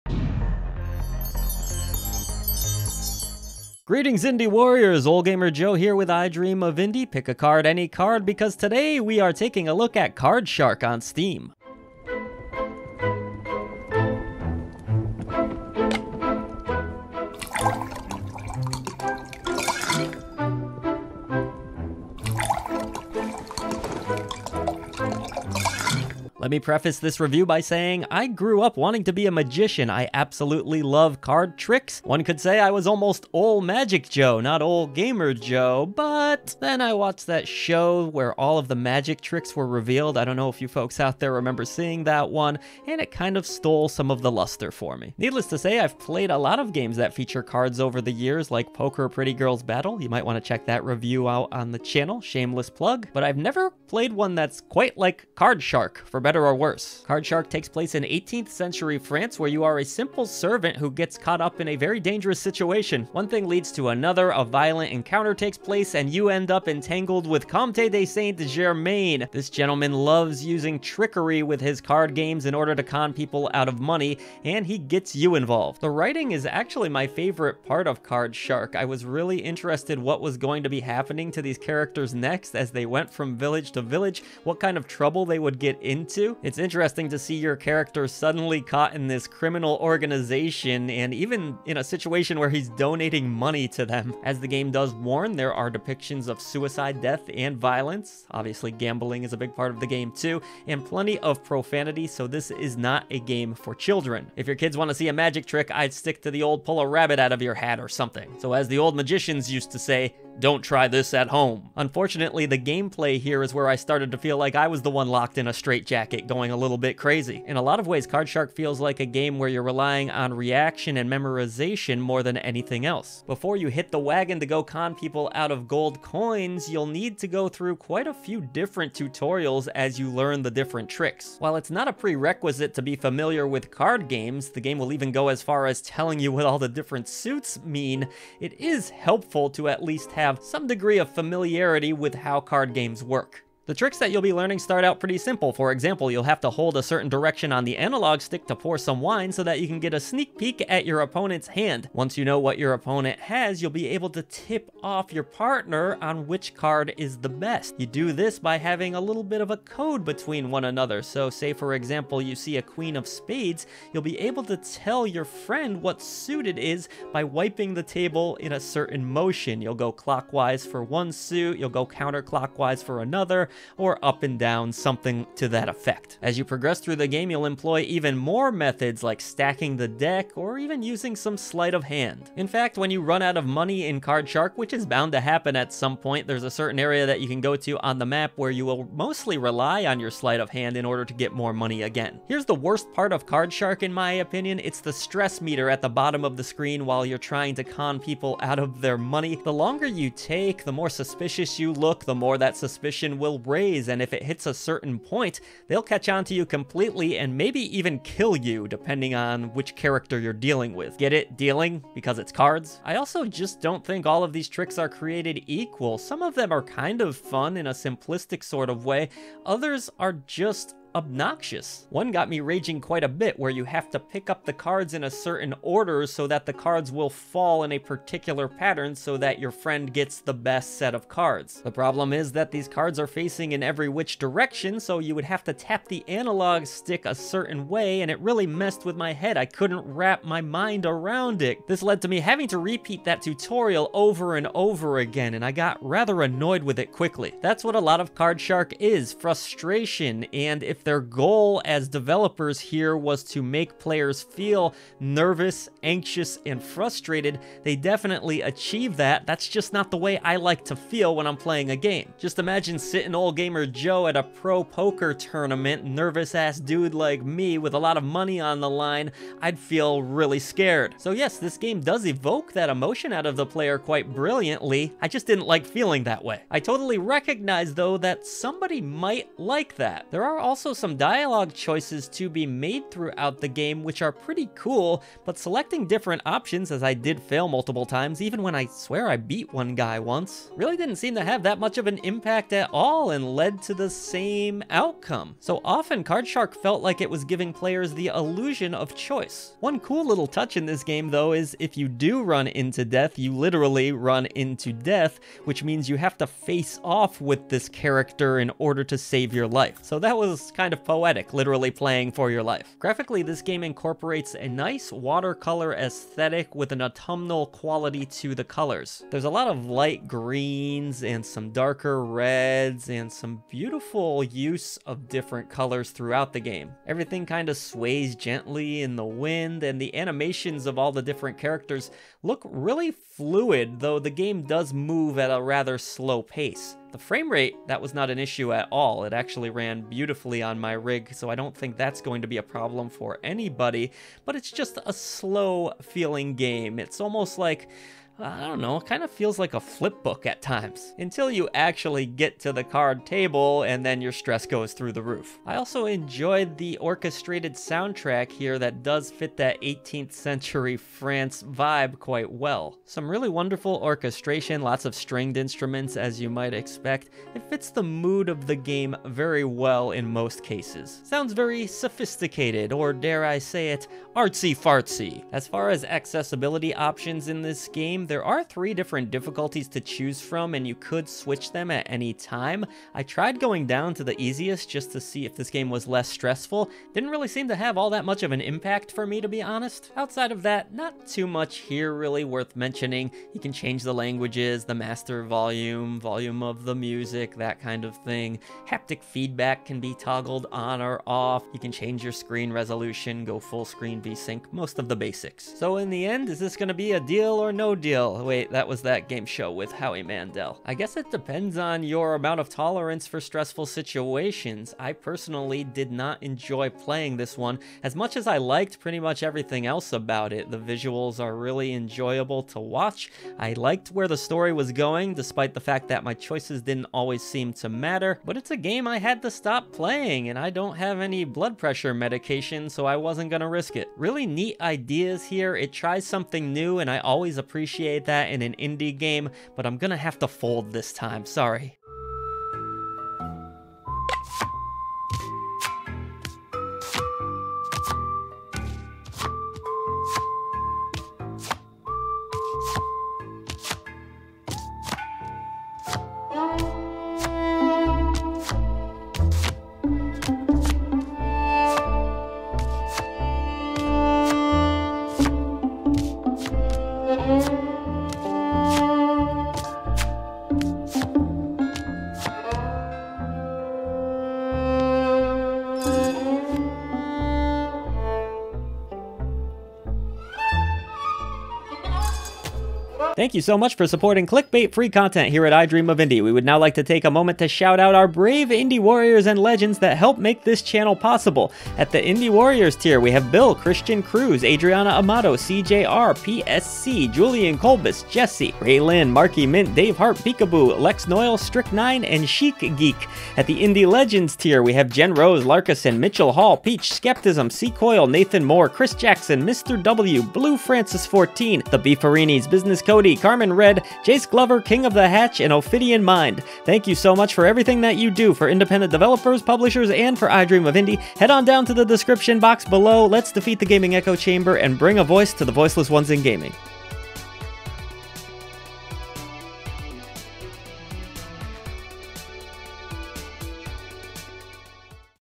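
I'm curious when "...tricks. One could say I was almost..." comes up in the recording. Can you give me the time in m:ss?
0:31.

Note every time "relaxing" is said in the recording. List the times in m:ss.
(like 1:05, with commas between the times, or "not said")
not said.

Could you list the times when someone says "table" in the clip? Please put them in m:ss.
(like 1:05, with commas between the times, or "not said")
2:47, 5:53.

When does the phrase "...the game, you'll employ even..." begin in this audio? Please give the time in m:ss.
2:56.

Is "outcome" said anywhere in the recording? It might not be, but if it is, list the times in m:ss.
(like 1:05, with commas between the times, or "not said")
4:54.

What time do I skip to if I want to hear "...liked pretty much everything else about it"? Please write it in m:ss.
6:58.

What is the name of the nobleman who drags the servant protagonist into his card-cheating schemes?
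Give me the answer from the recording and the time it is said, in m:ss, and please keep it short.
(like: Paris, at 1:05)
Comte de Saint-Germain, at 1:07.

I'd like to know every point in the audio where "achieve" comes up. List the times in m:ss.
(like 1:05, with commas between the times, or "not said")
4:18.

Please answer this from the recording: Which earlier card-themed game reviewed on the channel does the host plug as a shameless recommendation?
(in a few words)
Poker Pretty Girls Battle.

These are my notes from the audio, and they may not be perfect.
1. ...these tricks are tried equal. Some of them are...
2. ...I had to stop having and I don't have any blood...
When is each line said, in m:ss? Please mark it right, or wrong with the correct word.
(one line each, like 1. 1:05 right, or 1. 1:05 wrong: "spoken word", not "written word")
1. 3:34 wrong: "created", not "tried"
2. 7:08 wrong: "playing", not "having".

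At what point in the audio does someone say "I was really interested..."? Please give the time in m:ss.
1:18.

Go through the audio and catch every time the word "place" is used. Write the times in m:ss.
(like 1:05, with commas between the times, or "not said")
0:57, 1:05.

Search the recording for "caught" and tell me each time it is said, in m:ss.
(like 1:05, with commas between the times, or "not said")
1:01, 1:28.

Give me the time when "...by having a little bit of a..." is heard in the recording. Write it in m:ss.
2:38.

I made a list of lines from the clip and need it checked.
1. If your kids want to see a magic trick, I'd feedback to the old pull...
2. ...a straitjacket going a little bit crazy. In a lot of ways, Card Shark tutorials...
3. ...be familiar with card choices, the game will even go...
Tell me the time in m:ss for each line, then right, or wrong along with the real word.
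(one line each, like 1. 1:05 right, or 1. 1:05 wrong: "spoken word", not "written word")
1. 1:44 wrong: "stick", not "feedback"
2. 1:55 wrong: "feels", not "tutorials"
3. 2:12 wrong: "games", not "choices".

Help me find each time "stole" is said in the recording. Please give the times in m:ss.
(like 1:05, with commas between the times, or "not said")
0:43.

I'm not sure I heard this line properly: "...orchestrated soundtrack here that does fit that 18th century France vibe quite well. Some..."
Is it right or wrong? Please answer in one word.
right.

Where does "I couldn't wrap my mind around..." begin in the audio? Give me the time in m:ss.
3:59.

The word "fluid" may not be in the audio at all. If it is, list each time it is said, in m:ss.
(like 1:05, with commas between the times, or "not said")
5:32.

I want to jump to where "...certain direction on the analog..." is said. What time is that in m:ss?
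2:26.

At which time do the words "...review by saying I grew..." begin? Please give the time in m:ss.
0:27.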